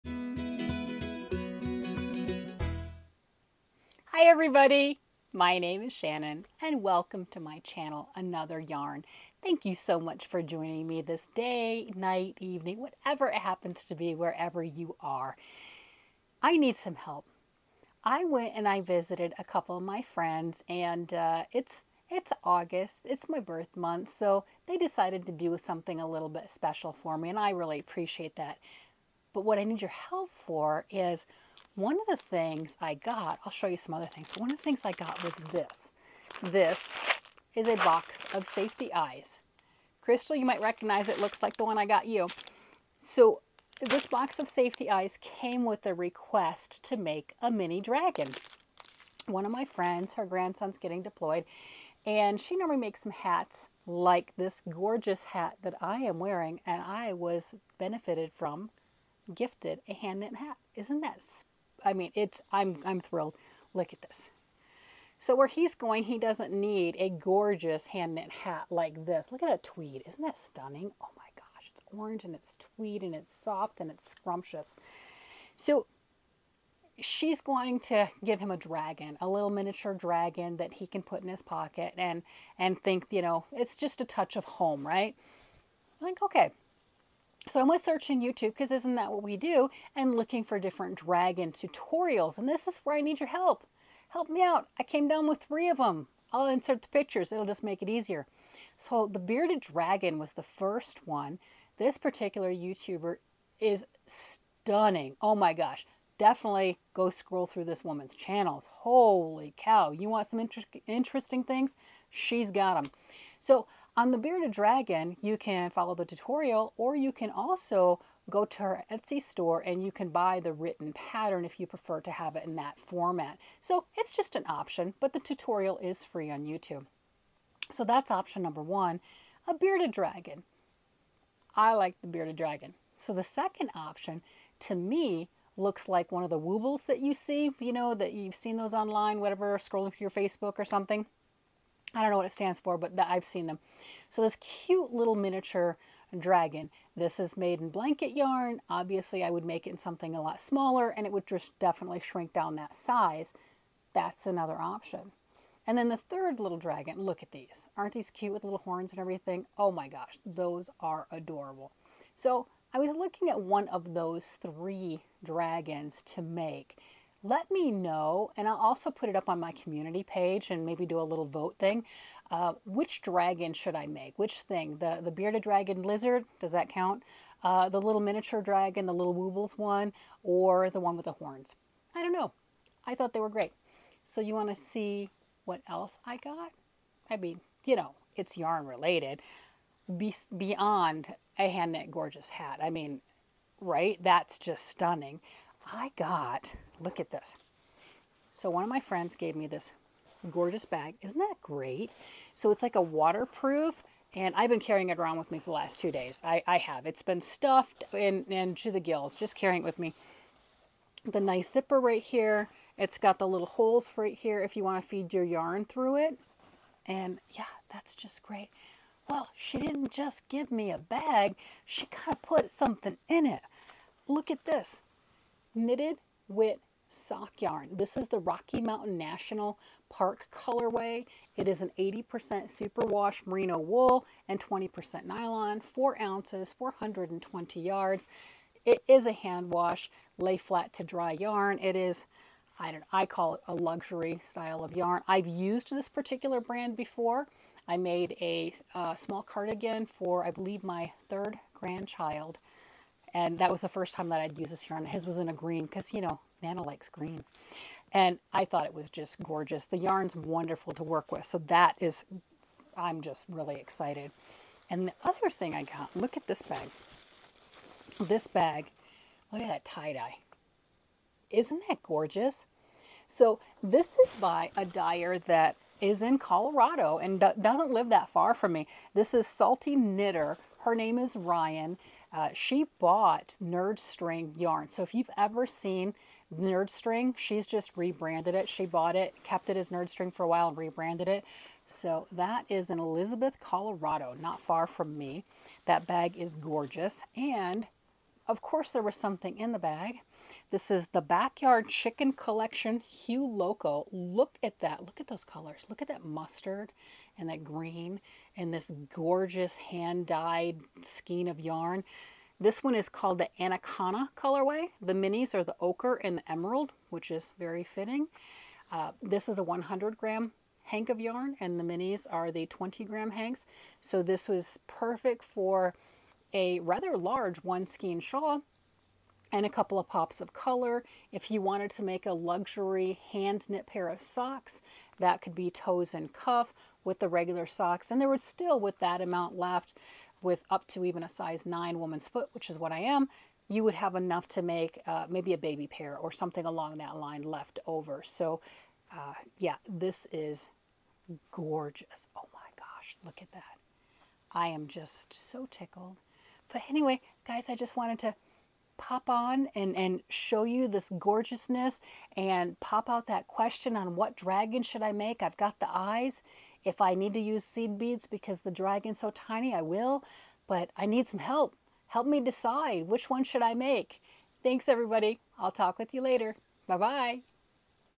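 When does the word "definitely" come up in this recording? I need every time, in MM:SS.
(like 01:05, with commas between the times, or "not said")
01:46, 02:31.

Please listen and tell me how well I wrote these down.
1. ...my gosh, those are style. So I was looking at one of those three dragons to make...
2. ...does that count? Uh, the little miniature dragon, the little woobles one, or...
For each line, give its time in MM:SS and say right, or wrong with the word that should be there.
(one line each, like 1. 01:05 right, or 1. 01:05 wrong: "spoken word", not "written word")
1. 02:39 wrong: "adorable", not "style"
2. 02:56 right.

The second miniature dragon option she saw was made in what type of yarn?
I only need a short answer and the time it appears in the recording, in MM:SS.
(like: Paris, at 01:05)
Blanket yarn, at 02:27.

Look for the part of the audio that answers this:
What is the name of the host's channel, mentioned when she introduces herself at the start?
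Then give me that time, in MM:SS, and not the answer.
00:08.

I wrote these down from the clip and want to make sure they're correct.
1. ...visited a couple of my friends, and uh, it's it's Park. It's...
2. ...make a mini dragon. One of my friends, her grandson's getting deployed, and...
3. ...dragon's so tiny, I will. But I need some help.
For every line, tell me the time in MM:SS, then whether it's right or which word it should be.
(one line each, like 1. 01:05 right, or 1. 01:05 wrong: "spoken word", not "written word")
1. 00:18 wrong: "August", not "Park"
2. 00:46 right
3. 06:08 right.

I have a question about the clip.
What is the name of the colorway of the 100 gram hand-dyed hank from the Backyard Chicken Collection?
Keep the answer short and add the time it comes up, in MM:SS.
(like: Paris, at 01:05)
Anaconda, at 05:13.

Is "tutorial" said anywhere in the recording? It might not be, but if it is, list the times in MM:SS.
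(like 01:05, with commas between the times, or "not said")
01:31, 01:56, 02:05.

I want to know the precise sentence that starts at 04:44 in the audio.
So if you've ever seen Nerd String, she's just rebranded it.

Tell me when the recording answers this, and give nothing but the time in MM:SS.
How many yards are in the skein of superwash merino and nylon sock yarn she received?
03:56.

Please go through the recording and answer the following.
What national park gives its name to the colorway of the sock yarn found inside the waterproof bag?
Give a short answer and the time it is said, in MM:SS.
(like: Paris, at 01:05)
Rocky Mountain National Park, at 03:48.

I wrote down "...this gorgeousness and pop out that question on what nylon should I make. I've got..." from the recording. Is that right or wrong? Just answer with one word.
wrong.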